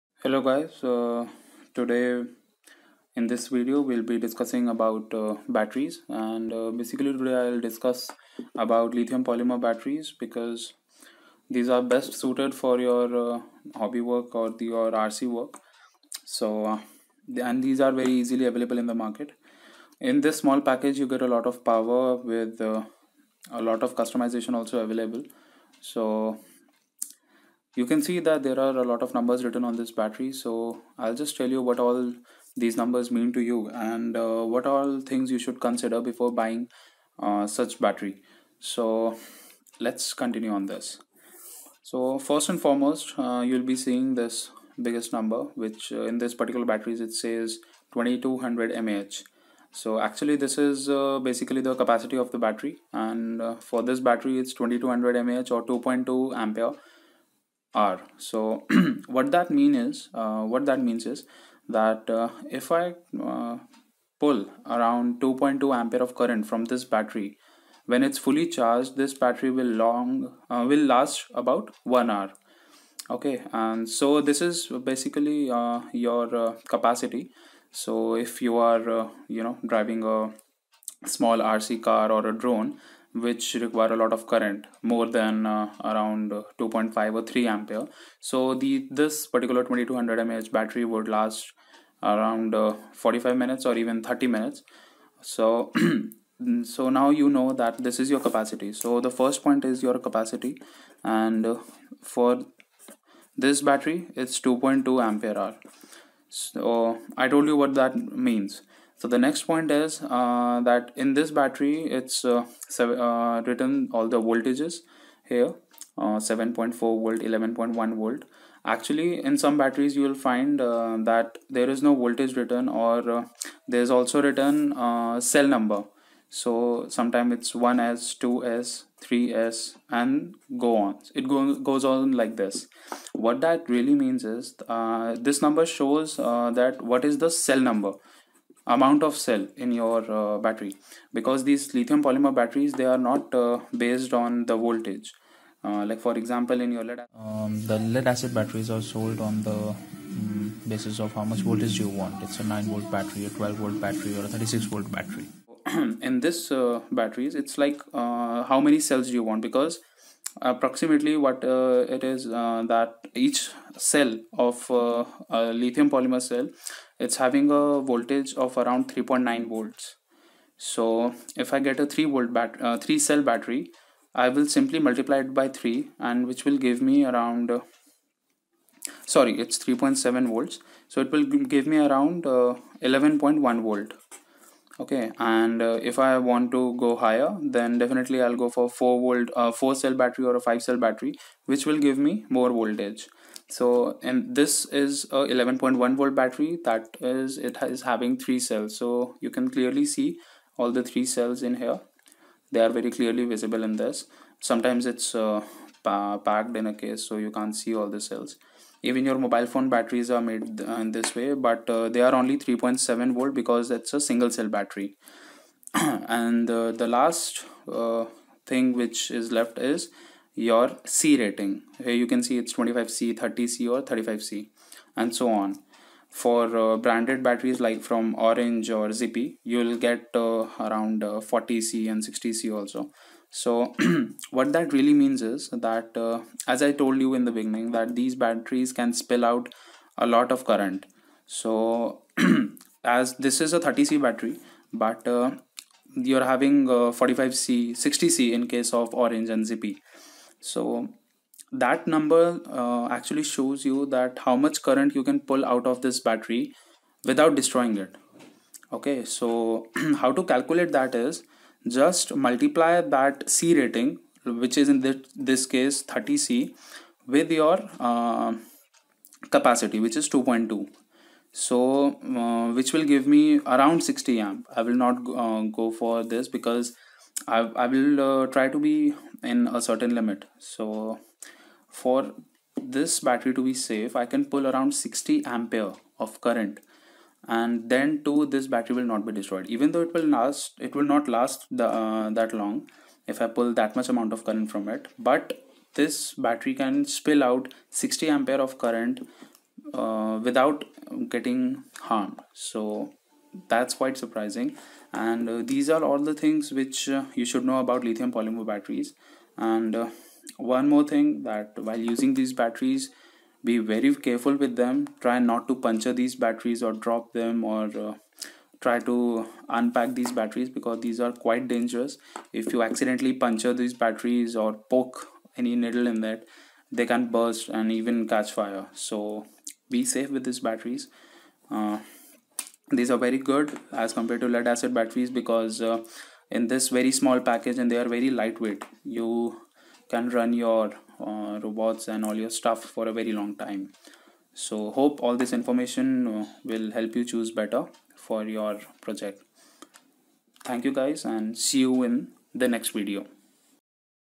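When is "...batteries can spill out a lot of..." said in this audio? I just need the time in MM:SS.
03:58.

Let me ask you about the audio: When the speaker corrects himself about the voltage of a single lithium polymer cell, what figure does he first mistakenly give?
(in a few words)
3.9 volts.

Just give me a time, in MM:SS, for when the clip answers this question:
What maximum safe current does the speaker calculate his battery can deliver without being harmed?
04:33.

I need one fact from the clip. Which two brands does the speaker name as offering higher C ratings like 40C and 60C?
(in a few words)
Orange and Zippy.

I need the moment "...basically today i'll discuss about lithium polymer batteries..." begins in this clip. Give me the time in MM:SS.
00:06.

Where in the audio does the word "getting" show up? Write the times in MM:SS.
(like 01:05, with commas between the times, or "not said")
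05:01.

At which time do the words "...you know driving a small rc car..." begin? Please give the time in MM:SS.
01:19.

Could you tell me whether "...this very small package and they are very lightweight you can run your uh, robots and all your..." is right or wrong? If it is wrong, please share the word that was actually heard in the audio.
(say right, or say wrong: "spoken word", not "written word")
right.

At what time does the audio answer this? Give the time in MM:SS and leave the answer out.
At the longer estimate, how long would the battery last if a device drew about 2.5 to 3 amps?
01:32.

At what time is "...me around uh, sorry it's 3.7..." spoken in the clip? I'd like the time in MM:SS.
02:56.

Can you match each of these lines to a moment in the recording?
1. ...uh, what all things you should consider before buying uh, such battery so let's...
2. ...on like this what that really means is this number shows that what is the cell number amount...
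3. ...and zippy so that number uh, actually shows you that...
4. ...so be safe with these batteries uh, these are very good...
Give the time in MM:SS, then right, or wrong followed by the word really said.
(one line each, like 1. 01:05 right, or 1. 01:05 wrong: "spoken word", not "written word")
1. 00:34 right
2. 02:11 right
3. 04:09 right
4. 05:28 right.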